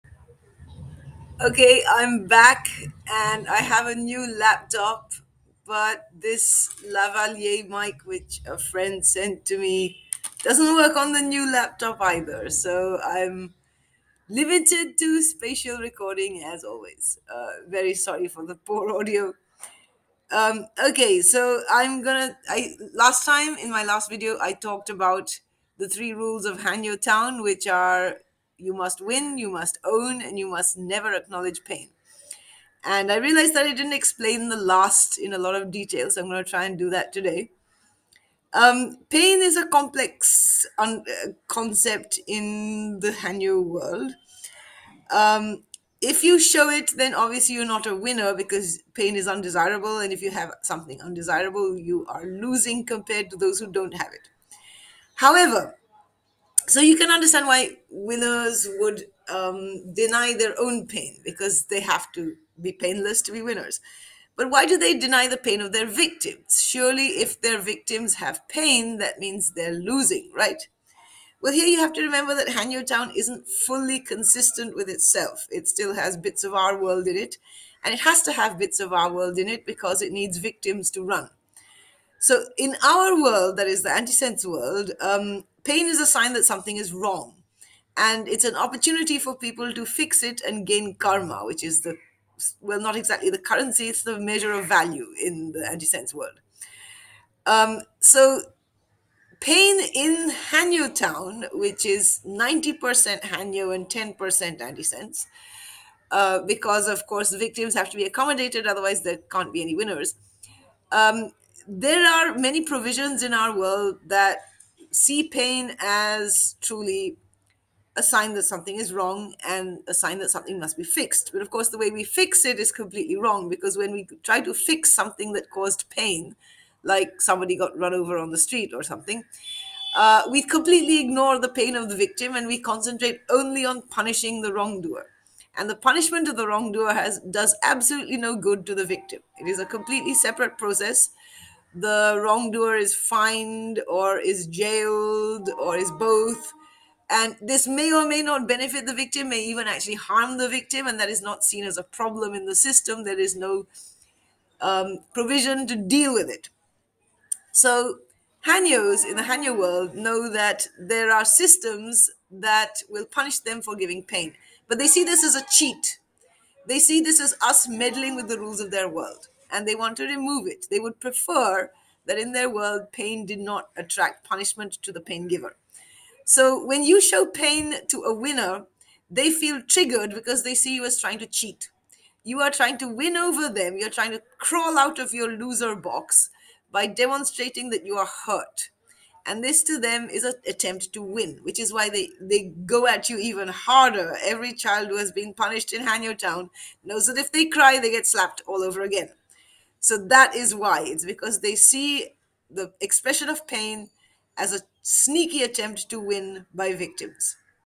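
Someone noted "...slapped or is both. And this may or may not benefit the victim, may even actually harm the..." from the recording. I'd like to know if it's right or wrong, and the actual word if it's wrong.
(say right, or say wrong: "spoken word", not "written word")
wrong: "jailed", not "slapped".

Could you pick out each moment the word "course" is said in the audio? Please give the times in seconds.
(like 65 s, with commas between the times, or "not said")
107 s, 121 s.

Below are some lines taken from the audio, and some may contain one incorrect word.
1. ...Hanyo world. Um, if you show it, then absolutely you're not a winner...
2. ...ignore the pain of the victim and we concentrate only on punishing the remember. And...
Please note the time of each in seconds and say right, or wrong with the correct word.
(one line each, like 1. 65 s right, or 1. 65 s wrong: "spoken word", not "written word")
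1. 43 s wrong: "obviously", not "absolutely"
2. 131 s wrong: "wrongdoer", not "remember".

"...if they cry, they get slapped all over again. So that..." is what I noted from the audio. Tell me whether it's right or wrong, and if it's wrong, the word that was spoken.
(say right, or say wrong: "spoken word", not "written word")
right.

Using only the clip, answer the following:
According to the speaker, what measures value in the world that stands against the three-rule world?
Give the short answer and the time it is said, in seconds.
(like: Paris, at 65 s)
karma, at 90 s.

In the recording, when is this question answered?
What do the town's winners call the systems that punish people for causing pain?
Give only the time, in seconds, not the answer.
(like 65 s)
165 s.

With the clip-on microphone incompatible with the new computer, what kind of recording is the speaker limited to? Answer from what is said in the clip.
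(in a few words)
spatial recording.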